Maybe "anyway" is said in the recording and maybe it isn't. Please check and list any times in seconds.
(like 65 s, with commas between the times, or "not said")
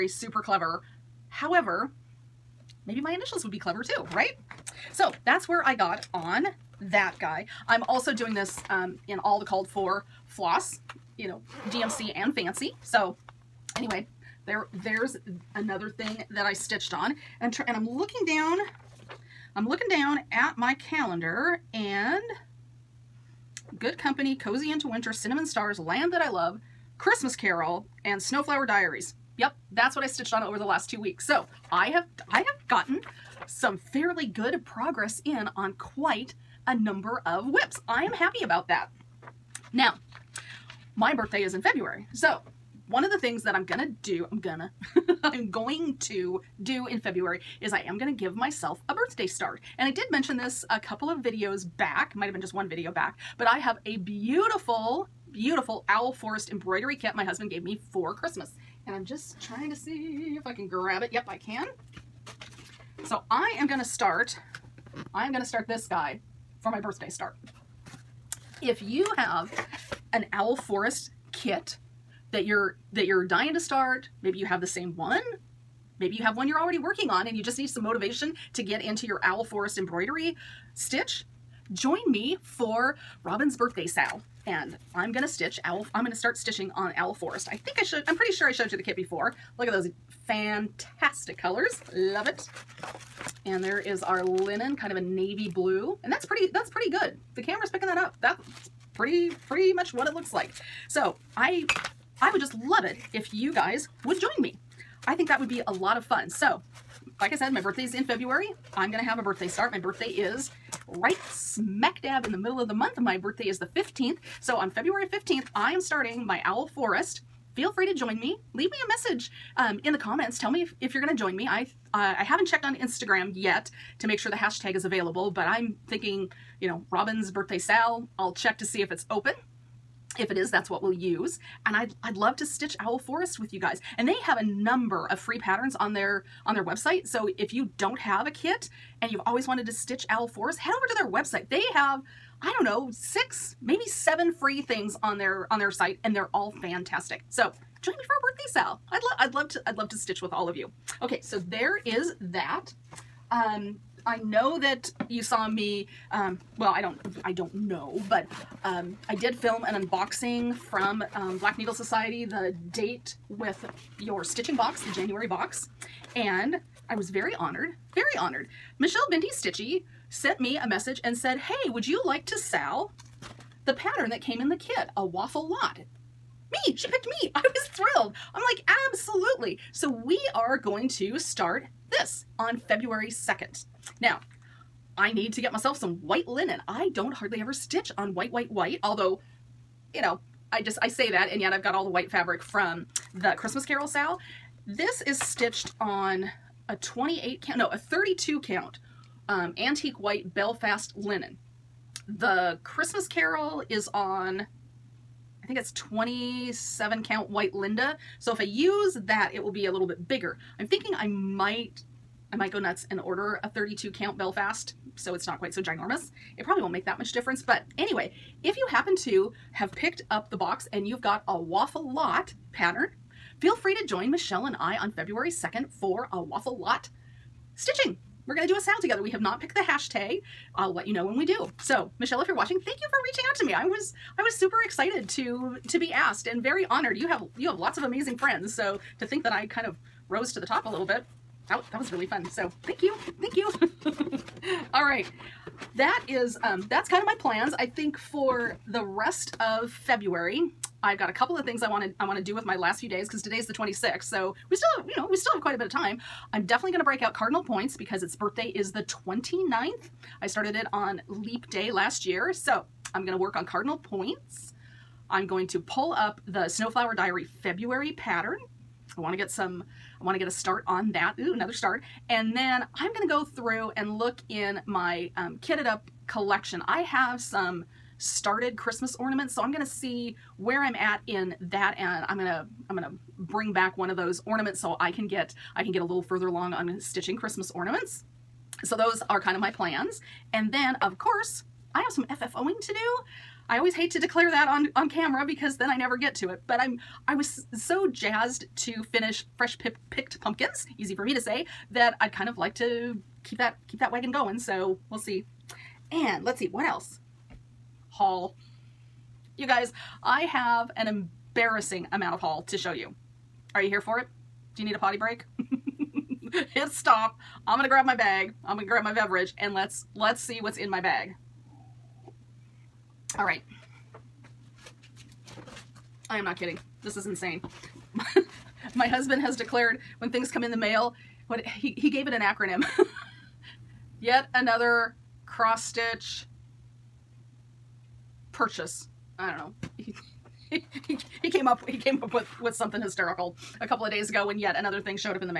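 13 s, 217 s.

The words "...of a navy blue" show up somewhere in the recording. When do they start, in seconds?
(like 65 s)
94 s.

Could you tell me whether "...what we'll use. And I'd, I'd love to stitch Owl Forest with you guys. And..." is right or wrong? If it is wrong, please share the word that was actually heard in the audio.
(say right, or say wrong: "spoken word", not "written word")
right.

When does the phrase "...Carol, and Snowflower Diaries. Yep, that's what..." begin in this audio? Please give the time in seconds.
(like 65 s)
27 s.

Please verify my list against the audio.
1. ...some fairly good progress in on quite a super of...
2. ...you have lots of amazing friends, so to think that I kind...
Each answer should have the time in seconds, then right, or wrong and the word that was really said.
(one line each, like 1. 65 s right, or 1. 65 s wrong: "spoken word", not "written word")
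1. 33 s wrong: "number", not "super"
2. 237 s right.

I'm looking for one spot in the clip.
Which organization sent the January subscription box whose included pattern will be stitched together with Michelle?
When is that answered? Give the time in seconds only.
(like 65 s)
161 s.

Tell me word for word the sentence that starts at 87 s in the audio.
I think I should, I'm pretty sure I showed you the kit before.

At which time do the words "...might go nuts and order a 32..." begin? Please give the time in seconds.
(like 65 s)
212 s.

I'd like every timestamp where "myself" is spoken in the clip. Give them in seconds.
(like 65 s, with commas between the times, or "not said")
48 s, 185 s.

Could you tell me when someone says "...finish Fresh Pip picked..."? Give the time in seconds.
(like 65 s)
298 s.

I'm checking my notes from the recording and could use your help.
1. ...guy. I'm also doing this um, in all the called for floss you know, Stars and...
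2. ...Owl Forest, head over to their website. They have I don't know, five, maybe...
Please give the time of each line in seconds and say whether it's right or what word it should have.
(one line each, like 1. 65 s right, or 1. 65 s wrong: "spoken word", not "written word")
1. 7 s wrong: "DMC", not "Stars"
2. 140 s wrong: "six", not "five".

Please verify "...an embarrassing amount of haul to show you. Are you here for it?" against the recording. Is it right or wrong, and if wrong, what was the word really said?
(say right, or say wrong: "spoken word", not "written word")
right.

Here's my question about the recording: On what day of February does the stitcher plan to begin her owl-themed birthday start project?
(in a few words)
15th.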